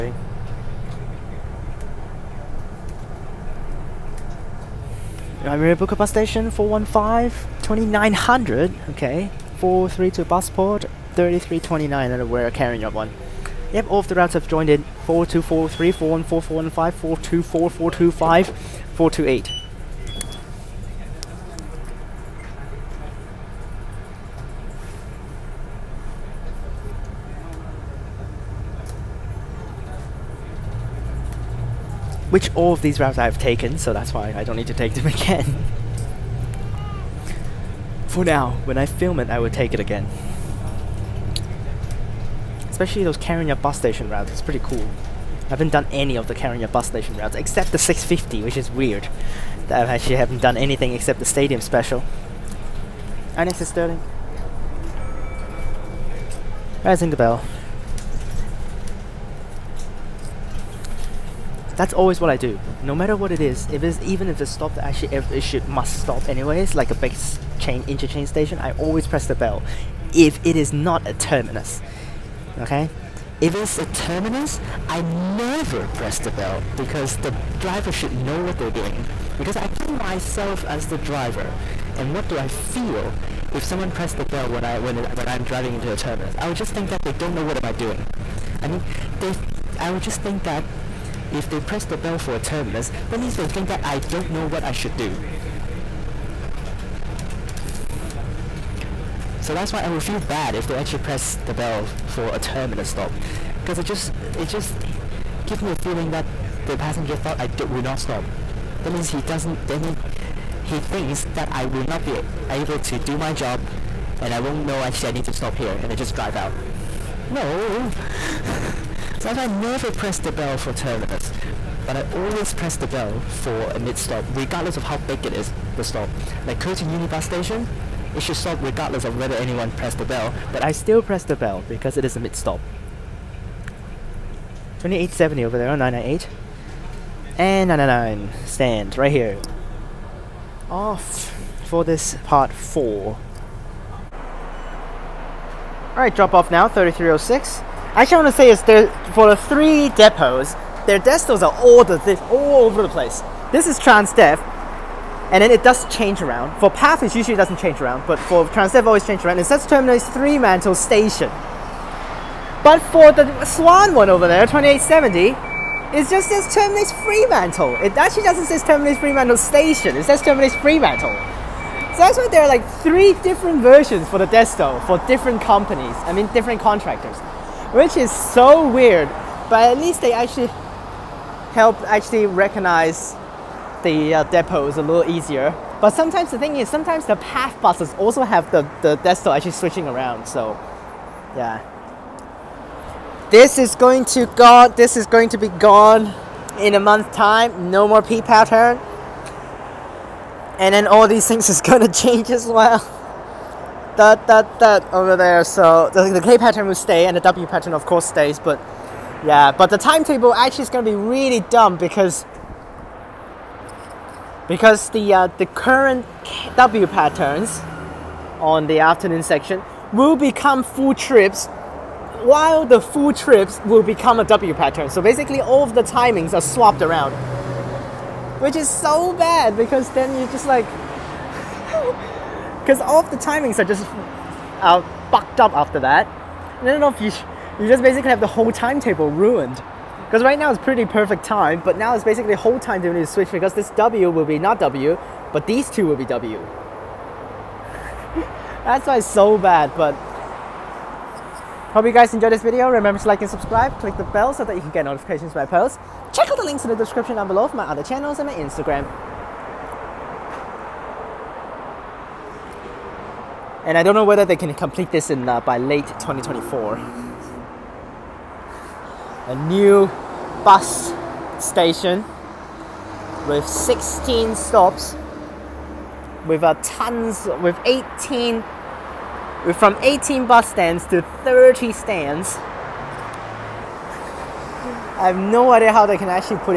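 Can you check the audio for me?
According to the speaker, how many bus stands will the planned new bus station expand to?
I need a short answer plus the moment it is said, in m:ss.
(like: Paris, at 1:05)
30, at 4:41.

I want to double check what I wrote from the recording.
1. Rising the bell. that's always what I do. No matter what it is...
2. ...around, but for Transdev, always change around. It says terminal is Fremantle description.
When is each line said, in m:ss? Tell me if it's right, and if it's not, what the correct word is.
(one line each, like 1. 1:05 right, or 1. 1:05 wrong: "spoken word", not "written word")
1. 0:56 right
2. 2:37 wrong: "station", not "description".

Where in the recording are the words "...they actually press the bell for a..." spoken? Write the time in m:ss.
1:40.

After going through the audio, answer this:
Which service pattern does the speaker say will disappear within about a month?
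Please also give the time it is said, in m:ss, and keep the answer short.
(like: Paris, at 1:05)
P pattern, at 3:18.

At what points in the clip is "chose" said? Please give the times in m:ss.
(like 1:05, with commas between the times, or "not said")
not said.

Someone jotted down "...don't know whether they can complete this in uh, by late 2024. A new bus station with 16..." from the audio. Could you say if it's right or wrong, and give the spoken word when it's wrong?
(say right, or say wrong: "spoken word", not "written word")
right.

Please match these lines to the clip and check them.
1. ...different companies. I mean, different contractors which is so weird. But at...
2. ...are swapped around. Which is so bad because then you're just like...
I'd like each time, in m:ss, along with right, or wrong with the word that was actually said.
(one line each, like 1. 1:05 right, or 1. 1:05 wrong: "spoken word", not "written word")
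1. 2:55 right
2. 3:46 right.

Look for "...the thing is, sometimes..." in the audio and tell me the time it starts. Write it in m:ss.
3:06.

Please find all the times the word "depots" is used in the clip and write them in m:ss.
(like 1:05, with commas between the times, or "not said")
2:29, 3:04.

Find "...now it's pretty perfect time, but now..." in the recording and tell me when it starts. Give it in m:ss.
4:00.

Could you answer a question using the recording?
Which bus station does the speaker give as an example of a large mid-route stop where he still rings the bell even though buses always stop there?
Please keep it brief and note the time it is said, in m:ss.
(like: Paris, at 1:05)
Curtin Unibus Station, at 2:06.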